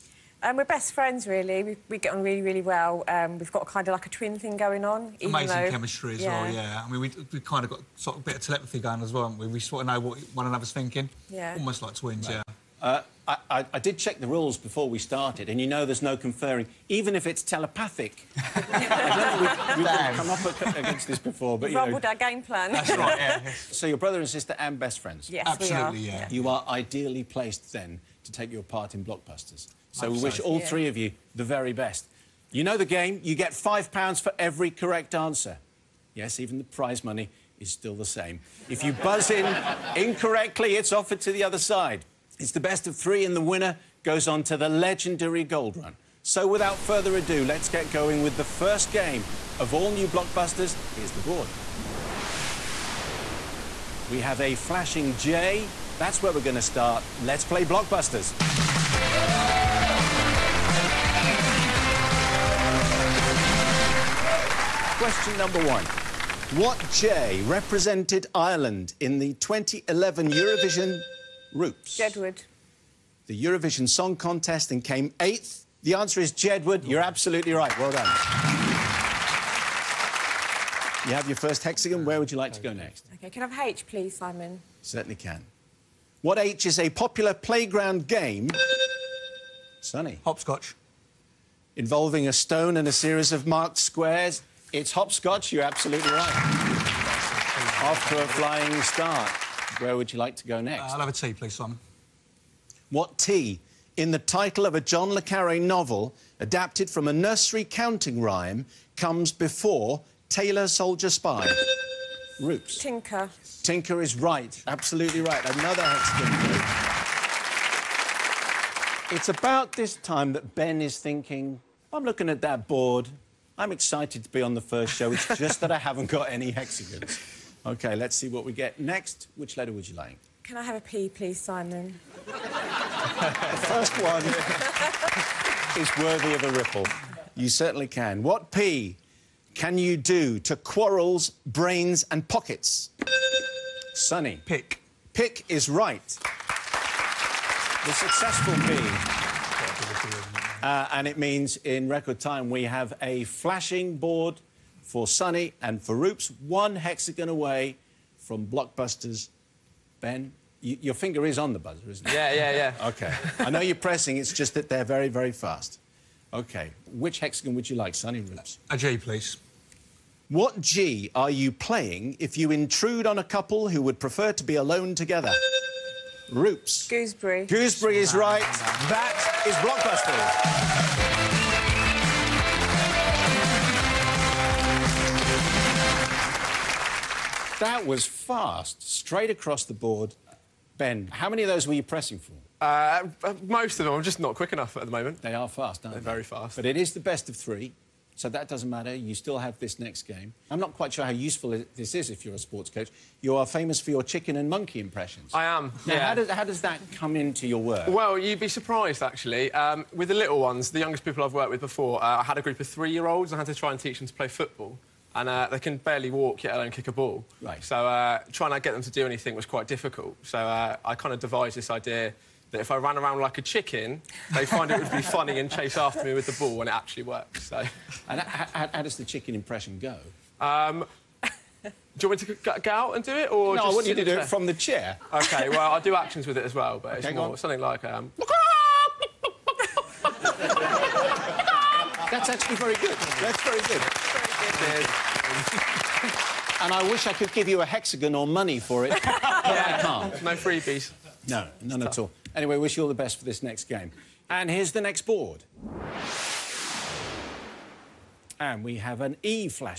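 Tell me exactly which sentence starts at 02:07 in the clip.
OK, let's see what we get next.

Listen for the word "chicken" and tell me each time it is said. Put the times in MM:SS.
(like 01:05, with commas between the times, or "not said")
03:24, 03:43, 03:49.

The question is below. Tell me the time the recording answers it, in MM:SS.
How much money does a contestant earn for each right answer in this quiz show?
00:33.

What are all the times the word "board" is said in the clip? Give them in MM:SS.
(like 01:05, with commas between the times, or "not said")
00:51, 02:02, 02:33, 03:09, 04:15.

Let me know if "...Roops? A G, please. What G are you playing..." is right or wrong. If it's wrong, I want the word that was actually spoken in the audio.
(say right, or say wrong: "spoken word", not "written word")
right.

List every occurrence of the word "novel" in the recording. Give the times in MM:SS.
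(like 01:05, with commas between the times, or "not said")
01:45.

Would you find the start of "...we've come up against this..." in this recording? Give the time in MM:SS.
00:19.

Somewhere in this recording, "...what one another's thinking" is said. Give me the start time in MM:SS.
00:09.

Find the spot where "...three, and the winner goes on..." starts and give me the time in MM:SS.
00:42.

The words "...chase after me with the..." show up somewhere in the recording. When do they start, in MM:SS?
03:45.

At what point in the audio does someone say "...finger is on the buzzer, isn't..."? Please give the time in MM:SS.
02:40.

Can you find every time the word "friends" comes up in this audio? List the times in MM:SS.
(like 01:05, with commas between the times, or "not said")
00:00, 00:24.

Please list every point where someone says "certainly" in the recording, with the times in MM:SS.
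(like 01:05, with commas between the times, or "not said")
01:24, 02:17.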